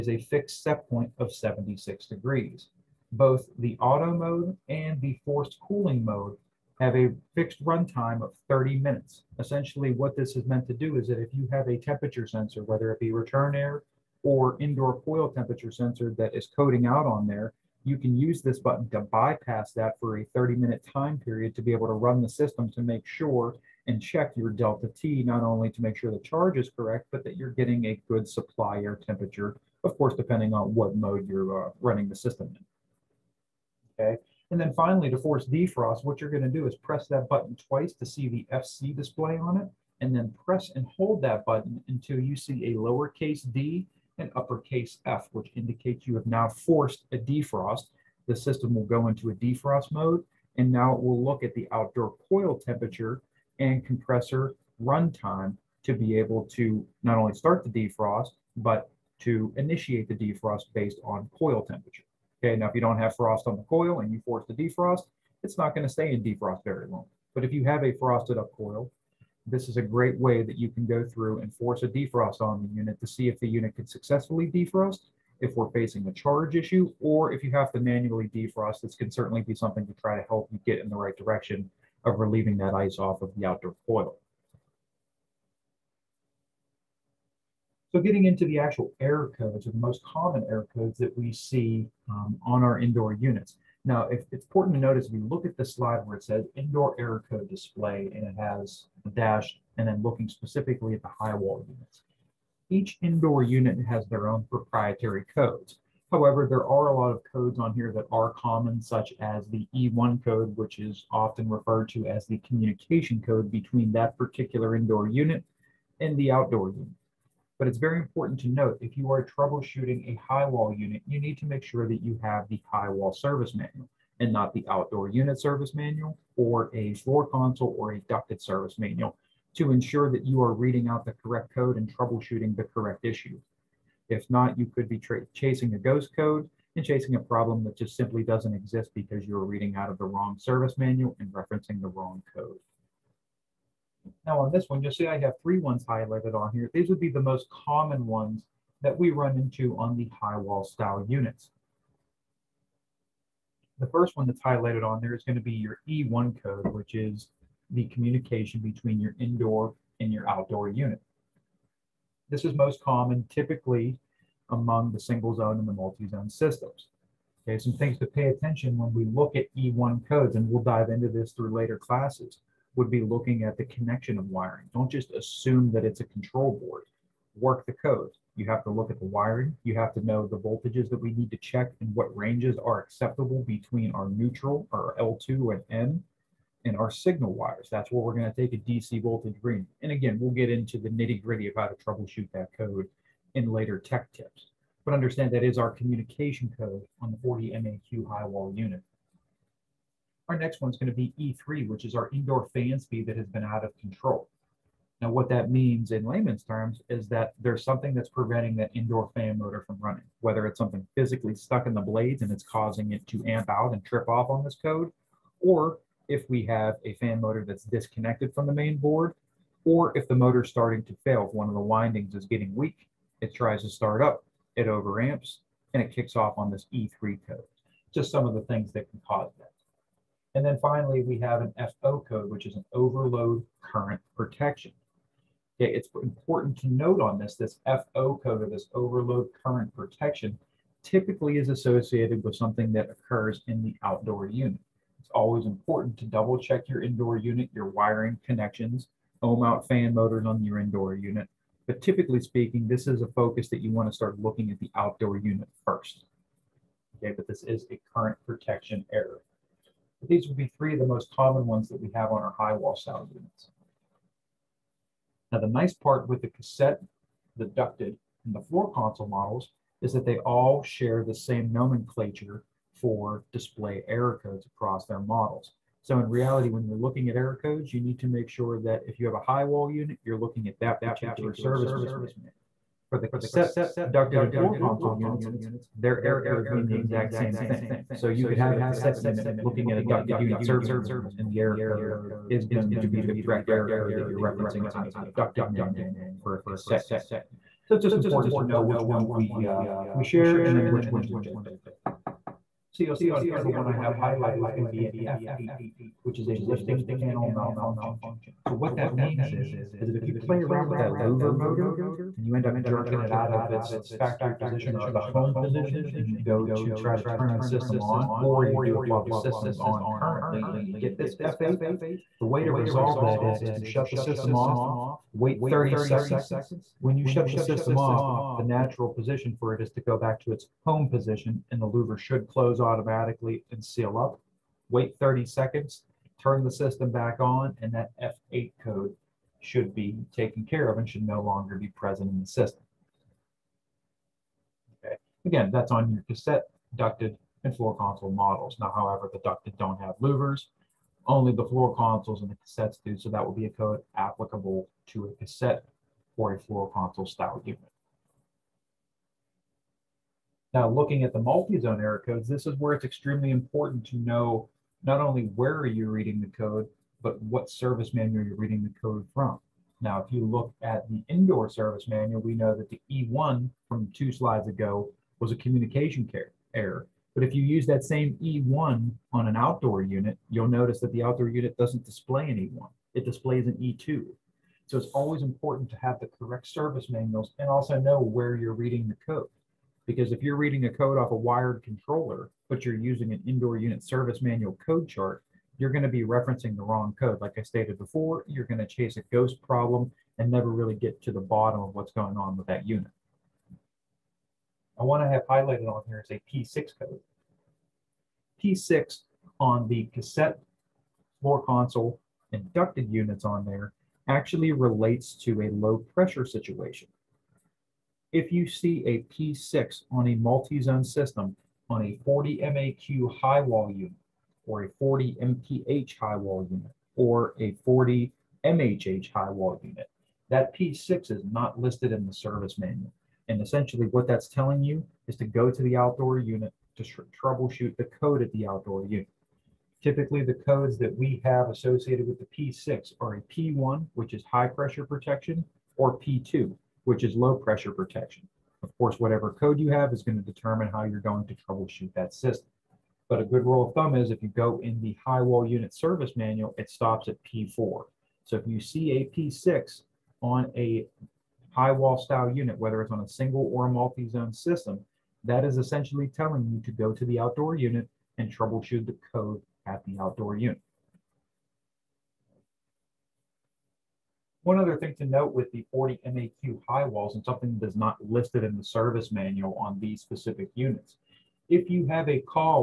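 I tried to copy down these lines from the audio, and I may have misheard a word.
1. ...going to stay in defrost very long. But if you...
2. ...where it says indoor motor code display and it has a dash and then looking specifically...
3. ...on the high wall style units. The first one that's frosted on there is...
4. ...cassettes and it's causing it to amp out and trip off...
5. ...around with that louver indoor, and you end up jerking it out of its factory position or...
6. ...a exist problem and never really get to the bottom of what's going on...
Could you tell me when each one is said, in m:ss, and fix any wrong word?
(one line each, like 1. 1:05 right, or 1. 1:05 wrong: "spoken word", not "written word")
1. 1:05 right
2. 1:36 wrong: "error", not "motor"
3. 2:29 wrong: "highlighted", not "frosted"
4. 3:31 wrong: "blades", not "cassettes"
5. 5:10 wrong: "motor", not "indoor"
6. 6:38 wrong: "ghost", not "exist".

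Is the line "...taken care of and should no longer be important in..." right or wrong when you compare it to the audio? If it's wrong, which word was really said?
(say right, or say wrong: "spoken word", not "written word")
wrong: "present", not "important".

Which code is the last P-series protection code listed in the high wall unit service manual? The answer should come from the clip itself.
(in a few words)
P4.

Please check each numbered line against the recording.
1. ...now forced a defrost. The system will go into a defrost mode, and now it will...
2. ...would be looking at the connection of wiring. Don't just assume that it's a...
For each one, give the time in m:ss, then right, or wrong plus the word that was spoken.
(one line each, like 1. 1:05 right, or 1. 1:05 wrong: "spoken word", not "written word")
1. 0:46 right
2. 2:52 right.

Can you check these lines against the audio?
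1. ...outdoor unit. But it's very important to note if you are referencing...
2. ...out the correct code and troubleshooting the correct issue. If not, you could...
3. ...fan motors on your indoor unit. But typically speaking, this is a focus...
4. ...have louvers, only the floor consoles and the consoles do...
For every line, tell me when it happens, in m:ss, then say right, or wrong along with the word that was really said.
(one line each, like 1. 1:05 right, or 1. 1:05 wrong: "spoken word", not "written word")
1. 1:56 wrong: "troubleshooting", not "referencing"
2. 2:10 right
3. 4:09 right
4. 5:49 wrong: "cassettes", not "consoles".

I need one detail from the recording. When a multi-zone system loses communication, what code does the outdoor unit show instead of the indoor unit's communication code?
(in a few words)
E2.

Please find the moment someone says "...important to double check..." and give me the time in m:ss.
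4:05.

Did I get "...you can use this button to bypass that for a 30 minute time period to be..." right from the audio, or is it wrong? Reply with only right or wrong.
right.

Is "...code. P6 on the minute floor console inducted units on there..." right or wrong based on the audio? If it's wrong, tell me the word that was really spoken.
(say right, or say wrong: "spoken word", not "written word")
wrong: "cassette", not "minute".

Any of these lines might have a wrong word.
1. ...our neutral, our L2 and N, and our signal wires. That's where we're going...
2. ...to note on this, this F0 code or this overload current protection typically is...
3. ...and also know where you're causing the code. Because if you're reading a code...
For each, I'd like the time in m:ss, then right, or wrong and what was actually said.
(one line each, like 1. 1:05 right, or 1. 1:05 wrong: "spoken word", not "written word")
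1. 3:03 right
2. 3:56 right
3. 6:27 wrong: "reading", not "causing".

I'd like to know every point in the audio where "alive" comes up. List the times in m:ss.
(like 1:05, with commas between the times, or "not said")
not said.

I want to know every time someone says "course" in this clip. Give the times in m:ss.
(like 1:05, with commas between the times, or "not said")
0:29, 7:28.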